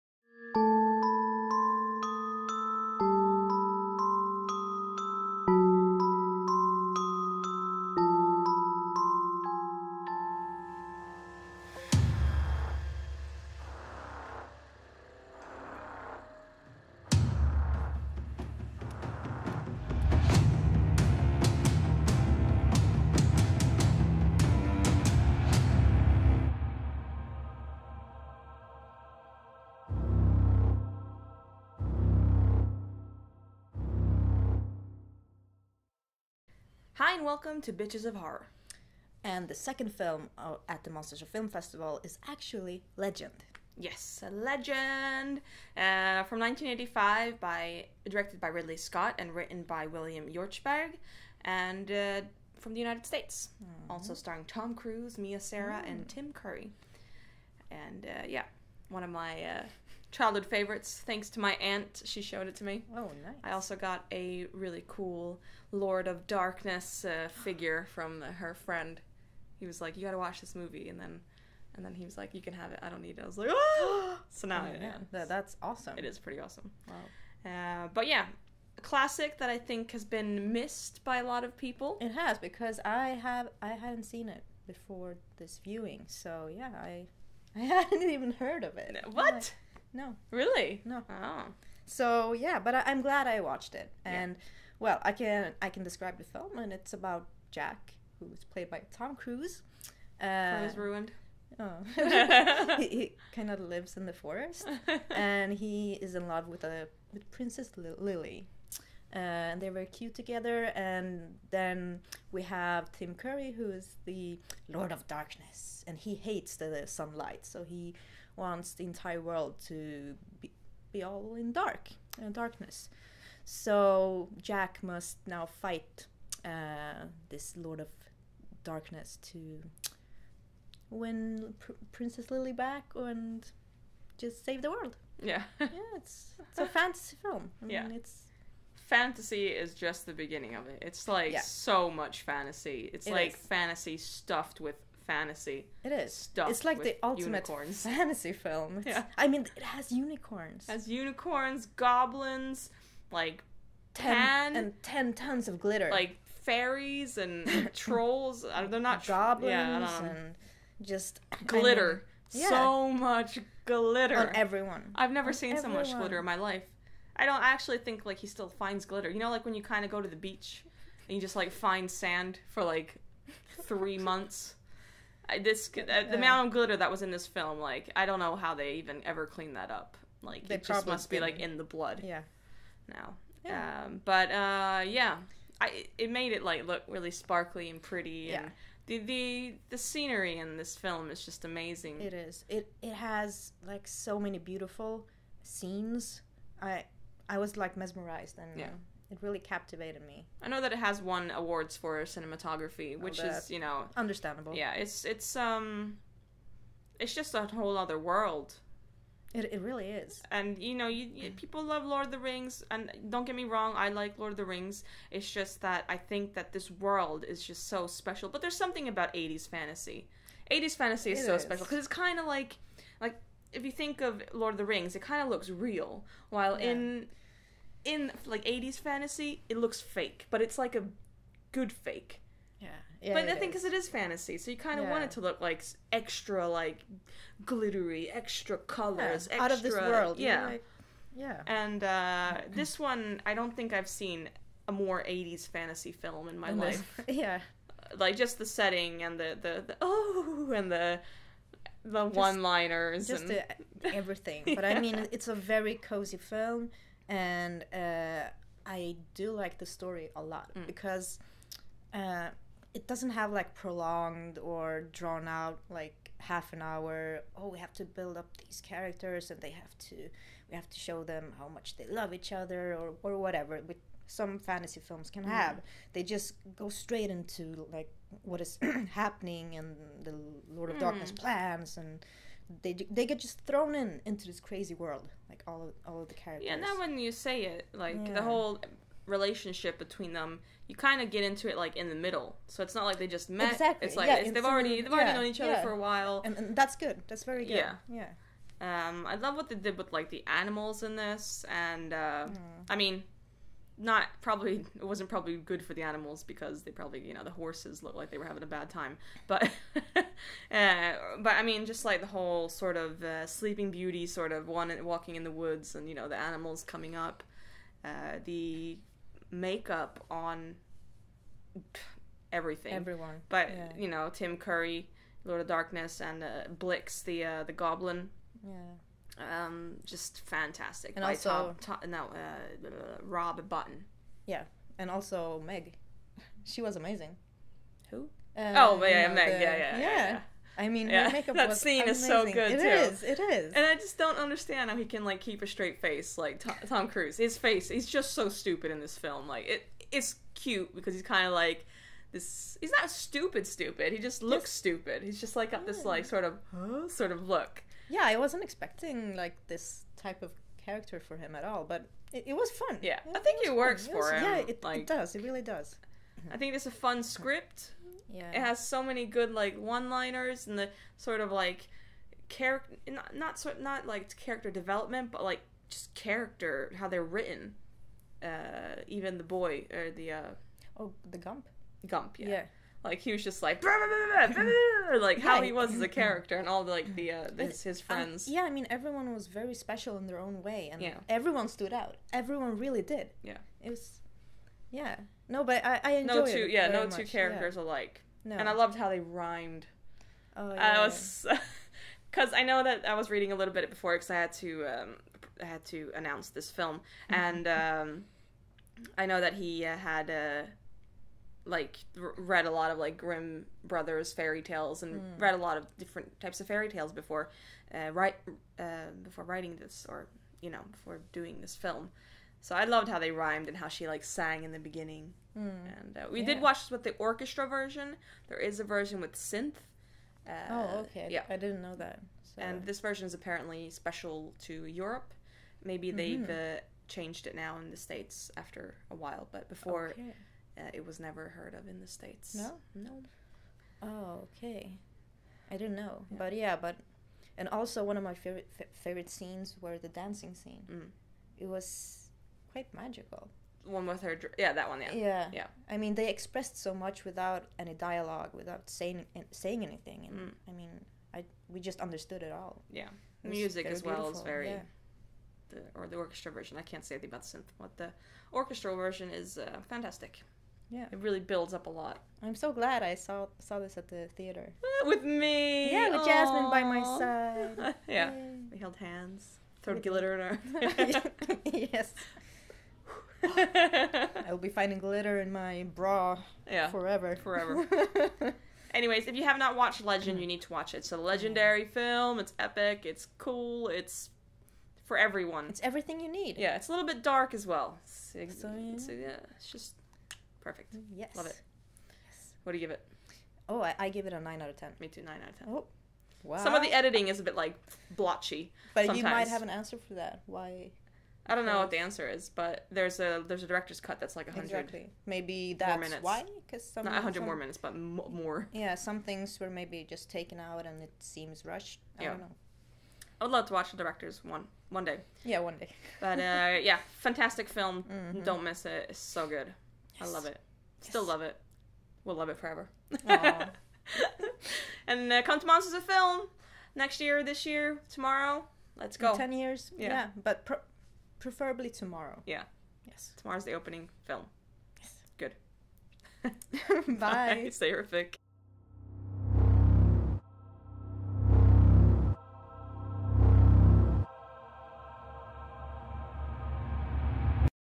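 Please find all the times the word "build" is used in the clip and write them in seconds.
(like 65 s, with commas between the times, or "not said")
267 s, 471 s.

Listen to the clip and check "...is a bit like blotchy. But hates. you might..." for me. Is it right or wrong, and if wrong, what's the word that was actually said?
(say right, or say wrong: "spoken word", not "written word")
wrong: "sometimes", not "hates".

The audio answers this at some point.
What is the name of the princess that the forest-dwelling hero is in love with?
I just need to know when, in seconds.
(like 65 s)
107 s.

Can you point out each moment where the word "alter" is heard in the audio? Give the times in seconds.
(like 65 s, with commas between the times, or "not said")
not said.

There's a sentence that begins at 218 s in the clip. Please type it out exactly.
But there's something about '80s fantasy.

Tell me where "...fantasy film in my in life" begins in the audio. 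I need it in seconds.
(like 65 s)
245 s.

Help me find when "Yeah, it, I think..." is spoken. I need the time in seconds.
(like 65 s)
362 s.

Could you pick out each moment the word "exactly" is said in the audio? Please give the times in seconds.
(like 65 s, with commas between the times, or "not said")
293 s, 514 s.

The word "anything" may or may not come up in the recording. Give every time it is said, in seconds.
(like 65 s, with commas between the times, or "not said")
459 s, 466 s.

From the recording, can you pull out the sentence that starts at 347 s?
His face, he's just so stupid in this film.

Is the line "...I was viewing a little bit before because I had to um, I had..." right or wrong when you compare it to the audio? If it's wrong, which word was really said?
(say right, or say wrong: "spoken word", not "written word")
wrong: "reading", not "viewing".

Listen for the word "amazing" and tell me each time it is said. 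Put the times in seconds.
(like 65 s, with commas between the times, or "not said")
191 s, 336 s, 341 s.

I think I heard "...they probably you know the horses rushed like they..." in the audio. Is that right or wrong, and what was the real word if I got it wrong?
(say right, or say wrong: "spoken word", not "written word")
wrong: "looked", not "rushed".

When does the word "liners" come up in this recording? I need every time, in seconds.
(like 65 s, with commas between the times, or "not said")
252 s, 369 s.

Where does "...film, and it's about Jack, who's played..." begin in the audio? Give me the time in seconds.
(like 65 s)
96 s.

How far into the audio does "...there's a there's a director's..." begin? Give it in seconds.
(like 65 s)
512 s.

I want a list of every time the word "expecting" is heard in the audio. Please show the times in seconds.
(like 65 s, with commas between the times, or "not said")
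358 s.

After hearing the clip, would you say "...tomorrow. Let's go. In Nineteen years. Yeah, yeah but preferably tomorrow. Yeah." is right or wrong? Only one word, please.
wrong.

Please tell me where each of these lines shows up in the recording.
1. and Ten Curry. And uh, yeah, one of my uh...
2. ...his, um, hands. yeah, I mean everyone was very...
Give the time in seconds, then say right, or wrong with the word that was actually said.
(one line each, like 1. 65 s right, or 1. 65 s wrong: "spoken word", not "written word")
1. 55 s wrong: "Tim", not "Ten"
2. 387 s wrong: "friends", not "hands".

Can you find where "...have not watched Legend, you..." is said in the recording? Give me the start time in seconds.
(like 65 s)
489 s.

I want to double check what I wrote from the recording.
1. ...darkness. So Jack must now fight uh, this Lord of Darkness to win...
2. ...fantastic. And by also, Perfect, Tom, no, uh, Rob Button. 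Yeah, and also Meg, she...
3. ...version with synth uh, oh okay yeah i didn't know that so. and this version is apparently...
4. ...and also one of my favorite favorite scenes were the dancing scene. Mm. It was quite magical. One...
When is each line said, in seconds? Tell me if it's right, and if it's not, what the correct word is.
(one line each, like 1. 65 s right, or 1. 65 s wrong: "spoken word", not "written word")
1. 122 s right
2. 330 s wrong: "Tom", not "Perfect"
3. 428 s right
4. 447 s right.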